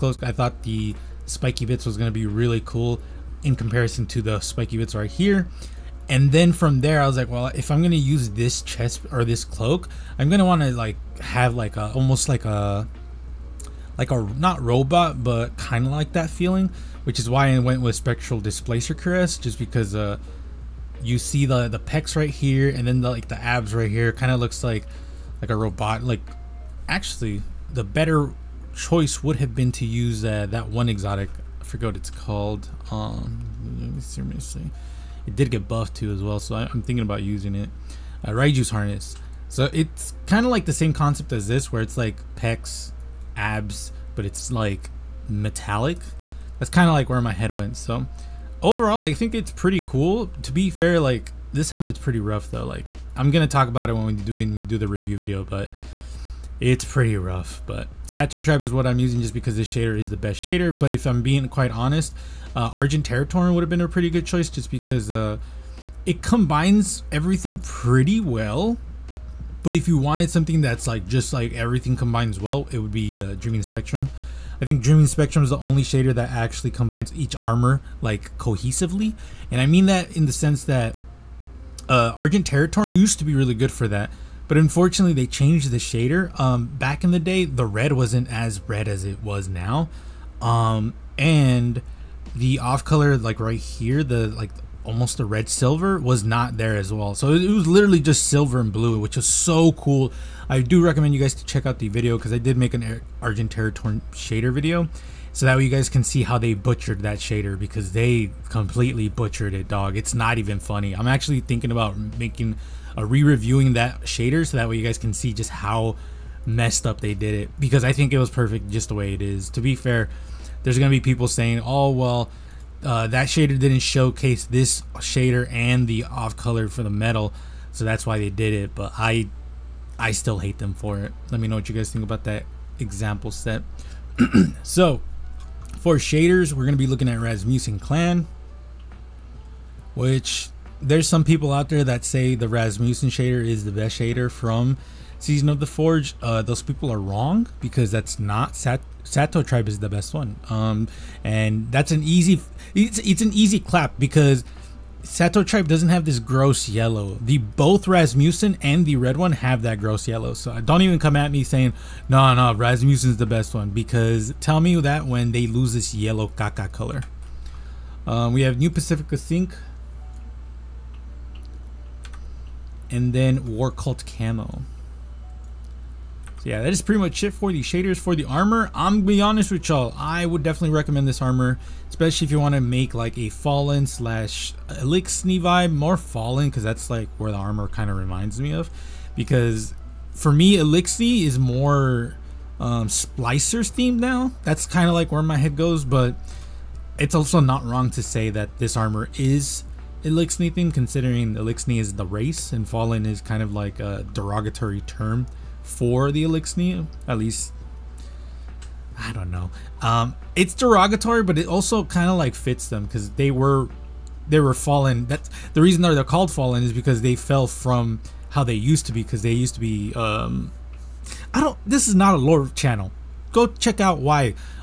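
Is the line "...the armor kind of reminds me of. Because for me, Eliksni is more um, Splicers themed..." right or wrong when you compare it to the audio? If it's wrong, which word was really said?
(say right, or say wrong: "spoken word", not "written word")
right.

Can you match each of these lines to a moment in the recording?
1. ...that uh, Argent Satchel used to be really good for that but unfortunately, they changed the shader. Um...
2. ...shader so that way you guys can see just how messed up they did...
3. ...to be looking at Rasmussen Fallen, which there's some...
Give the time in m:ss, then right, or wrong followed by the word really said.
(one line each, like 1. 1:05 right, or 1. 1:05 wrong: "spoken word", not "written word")
1. 1:20 wrong: "Territorin", not "Satchel"
2. 1:54 right
3. 2:16 wrong: "Clan", not "Fallen".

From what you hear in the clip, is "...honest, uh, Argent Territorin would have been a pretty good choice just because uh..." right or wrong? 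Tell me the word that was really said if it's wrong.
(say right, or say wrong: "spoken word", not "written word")
right.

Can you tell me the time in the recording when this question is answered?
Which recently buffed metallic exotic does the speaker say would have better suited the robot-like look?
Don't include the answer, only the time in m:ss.
0:38.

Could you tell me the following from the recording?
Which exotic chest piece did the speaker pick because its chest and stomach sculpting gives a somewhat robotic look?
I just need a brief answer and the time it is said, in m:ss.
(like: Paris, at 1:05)
Spectral Displacer Cuirass, at 0:17.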